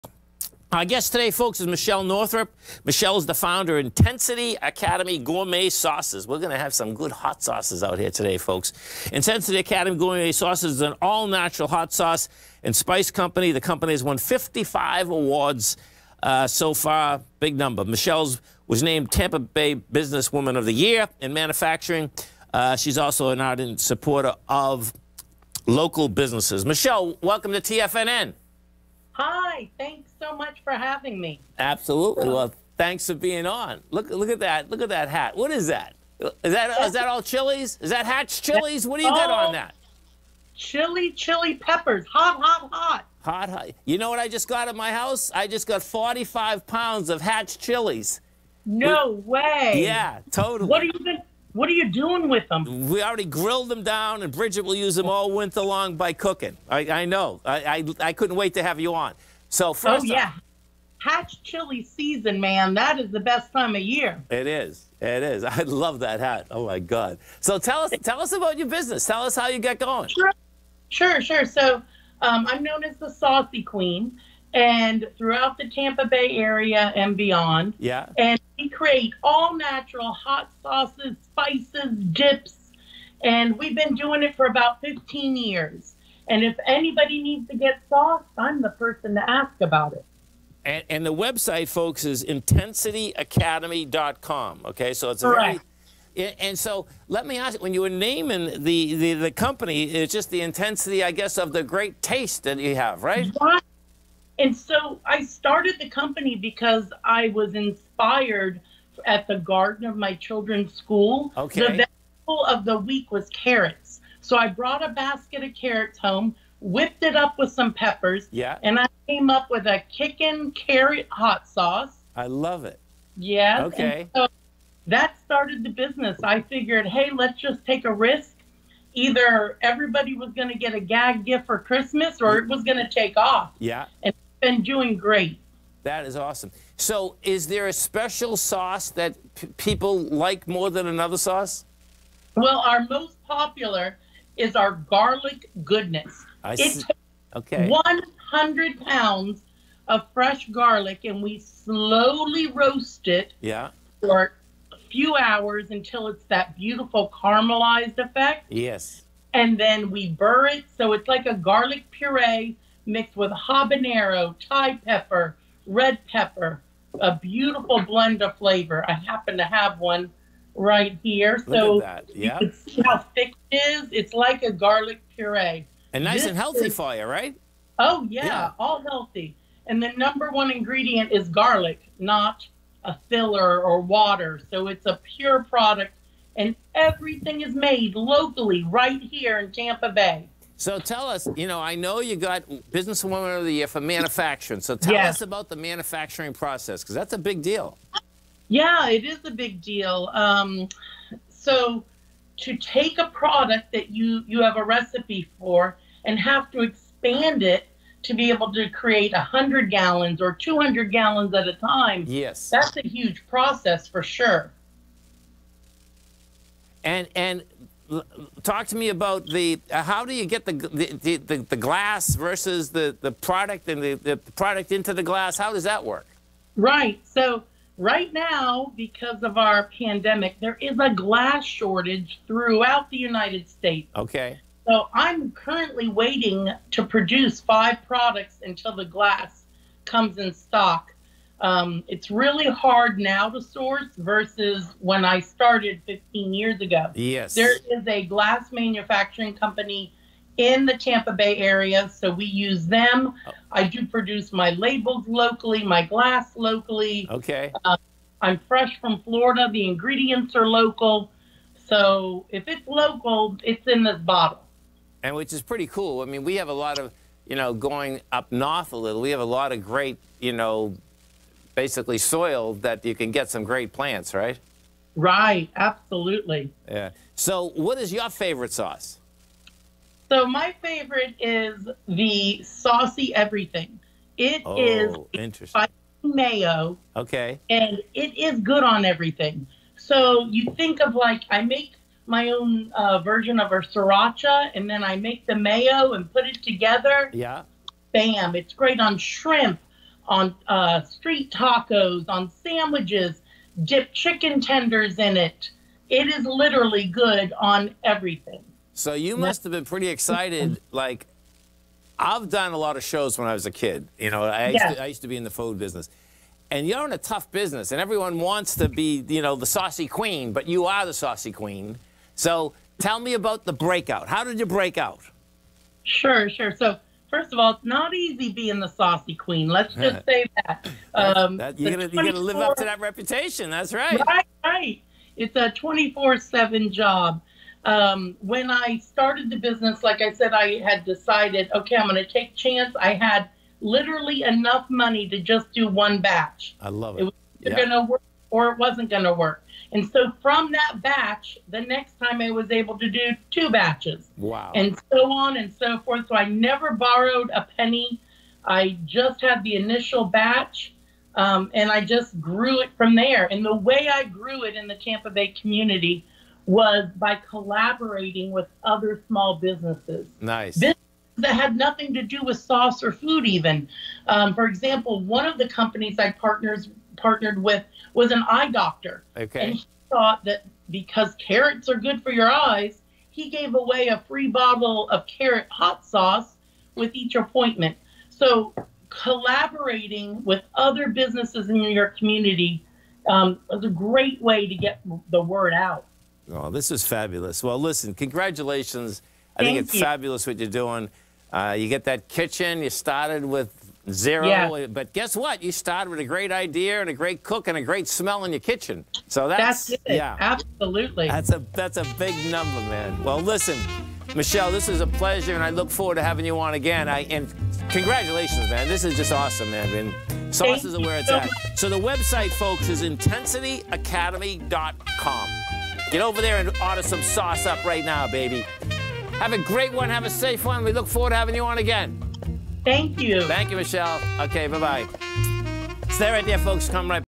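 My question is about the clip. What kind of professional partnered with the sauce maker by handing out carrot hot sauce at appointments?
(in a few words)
Eye doctor.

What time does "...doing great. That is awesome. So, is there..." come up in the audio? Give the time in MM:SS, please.
02:14.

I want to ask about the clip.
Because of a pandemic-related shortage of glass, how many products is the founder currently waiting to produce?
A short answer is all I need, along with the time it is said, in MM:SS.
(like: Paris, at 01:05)
5, at 03:57.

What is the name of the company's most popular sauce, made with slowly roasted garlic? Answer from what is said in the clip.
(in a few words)
Garlic Goodness.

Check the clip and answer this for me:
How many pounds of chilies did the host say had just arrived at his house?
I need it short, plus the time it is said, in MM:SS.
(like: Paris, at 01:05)
45 pounds, at 00:45.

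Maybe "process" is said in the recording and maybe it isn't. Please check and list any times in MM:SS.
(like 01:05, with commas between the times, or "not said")
03:16, 03:33.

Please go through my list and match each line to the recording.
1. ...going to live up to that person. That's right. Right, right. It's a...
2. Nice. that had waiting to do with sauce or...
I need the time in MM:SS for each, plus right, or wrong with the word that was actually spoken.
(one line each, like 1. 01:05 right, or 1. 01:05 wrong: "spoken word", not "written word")
1. 05:31 wrong: "reputation", not "person"
2. 06:10 wrong: "nothing", not "waiting".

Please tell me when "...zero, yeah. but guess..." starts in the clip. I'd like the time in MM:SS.
06:43.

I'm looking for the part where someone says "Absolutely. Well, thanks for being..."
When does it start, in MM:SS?
00:31.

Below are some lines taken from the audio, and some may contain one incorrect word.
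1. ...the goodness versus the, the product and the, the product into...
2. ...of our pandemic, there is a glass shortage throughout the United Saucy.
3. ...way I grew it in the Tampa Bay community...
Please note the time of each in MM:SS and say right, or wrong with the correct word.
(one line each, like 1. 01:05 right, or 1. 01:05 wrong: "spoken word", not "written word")
1. 03:41 wrong: "glass", not "goodness"
2. 03:49 wrong: "States", not "Saucy"
3. 06:03 right.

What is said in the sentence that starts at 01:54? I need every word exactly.
So I brought a basket of carrots home, whipped it up with some peppers, yeah.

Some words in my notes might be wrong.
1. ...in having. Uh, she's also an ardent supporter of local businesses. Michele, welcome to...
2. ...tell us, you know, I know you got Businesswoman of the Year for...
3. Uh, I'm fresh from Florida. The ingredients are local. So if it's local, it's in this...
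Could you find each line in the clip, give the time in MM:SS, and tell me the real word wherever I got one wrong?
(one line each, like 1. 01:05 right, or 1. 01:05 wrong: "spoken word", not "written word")
1. 00:21 wrong: "manufacturing", not "having"
2. 03:10 right
3. 04:17 right.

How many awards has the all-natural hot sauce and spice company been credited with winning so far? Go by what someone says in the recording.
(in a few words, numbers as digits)
55.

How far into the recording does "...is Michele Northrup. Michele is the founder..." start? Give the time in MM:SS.
00:01.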